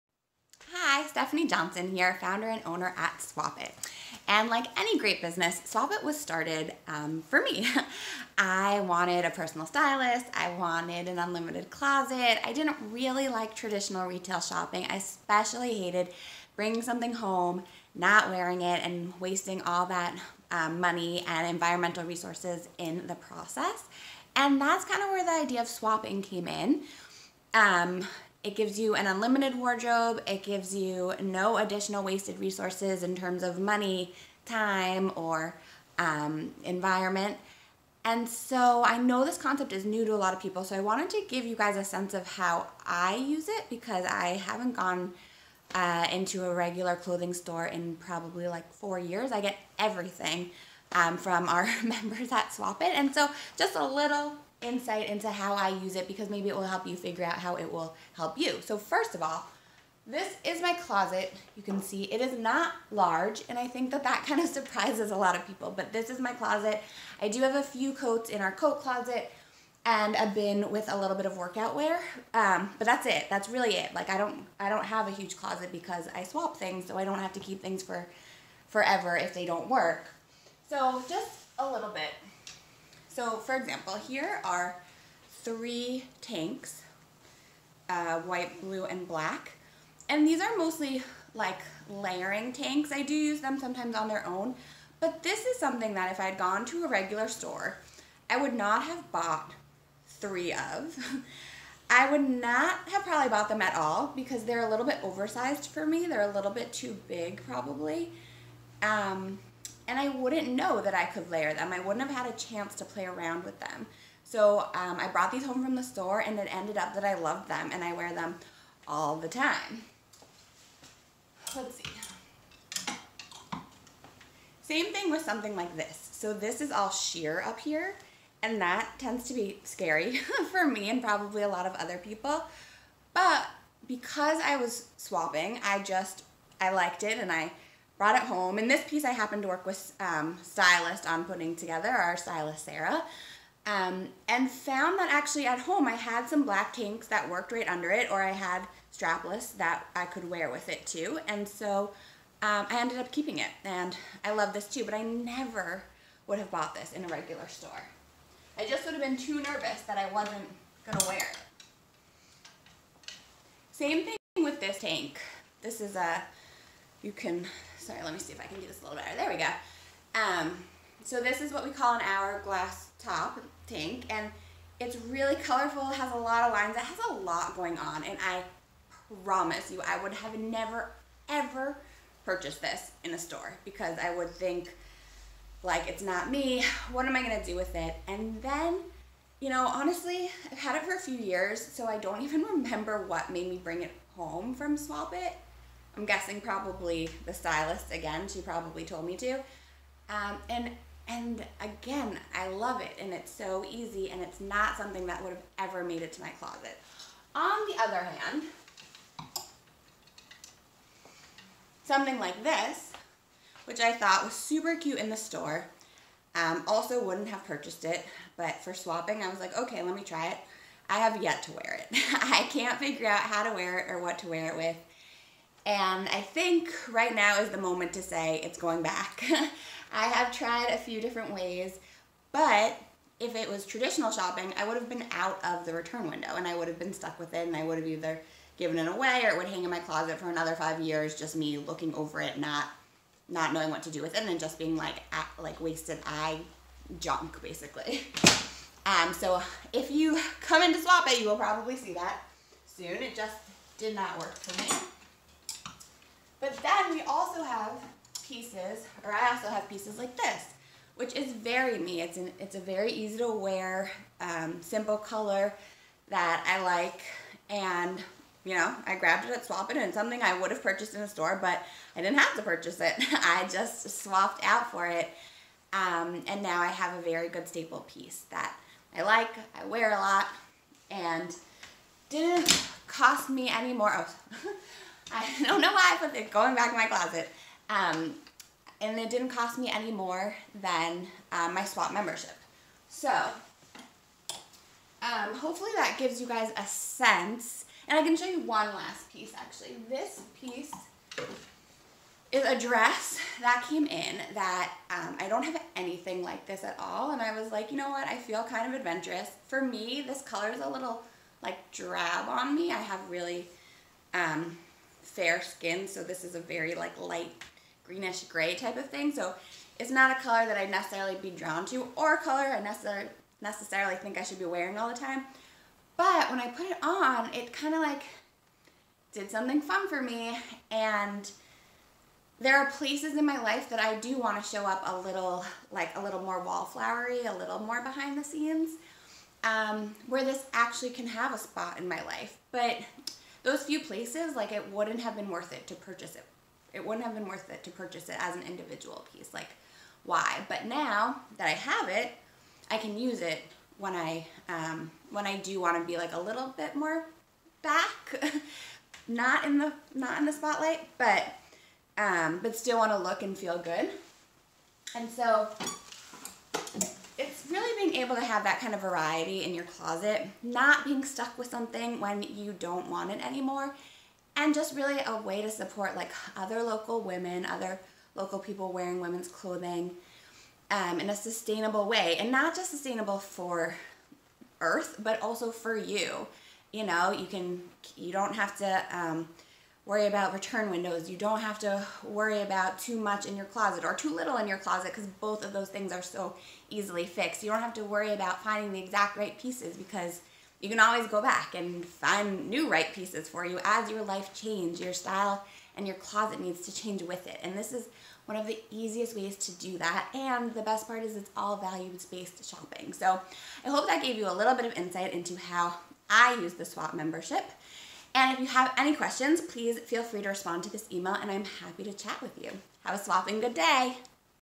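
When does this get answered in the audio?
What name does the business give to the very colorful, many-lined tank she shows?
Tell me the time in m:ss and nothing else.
2:52.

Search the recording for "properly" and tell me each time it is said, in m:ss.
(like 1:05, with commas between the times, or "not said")
not said.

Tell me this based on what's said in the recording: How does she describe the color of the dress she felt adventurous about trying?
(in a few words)
light greenish gray.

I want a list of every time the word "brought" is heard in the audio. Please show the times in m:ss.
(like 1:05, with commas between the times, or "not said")
1:55, 2:18.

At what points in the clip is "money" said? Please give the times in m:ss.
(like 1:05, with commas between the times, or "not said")
0:20, 0:33.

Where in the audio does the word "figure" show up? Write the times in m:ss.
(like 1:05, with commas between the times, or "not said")
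0:56, 3:42.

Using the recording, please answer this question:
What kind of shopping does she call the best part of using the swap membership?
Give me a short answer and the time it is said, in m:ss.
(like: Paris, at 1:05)
values-based shopping, at 6:51.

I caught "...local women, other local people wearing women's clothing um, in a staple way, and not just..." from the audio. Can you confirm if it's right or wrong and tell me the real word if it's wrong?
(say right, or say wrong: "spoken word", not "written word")
wrong: "sustainable", not "staple".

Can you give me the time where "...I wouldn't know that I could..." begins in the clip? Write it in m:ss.
1:49.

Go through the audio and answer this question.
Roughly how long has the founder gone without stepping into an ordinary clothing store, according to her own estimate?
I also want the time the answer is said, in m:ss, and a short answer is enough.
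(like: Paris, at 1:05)
4 years, at 0:48.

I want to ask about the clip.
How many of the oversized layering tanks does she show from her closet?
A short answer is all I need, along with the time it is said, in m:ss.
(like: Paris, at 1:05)
3, at 1:25.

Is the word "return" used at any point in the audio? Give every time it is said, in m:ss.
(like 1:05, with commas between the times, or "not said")
3:55, 6:30.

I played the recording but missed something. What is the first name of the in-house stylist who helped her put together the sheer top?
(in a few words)
Sarah.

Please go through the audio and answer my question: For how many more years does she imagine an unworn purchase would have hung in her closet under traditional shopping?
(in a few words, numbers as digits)
5.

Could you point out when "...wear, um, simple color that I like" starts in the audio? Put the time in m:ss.
4:23.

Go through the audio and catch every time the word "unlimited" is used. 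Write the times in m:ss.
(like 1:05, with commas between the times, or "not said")
0:11, 0:29.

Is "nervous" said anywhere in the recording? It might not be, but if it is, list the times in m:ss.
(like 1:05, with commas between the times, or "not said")
2:39.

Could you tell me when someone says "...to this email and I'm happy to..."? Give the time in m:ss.
7:00.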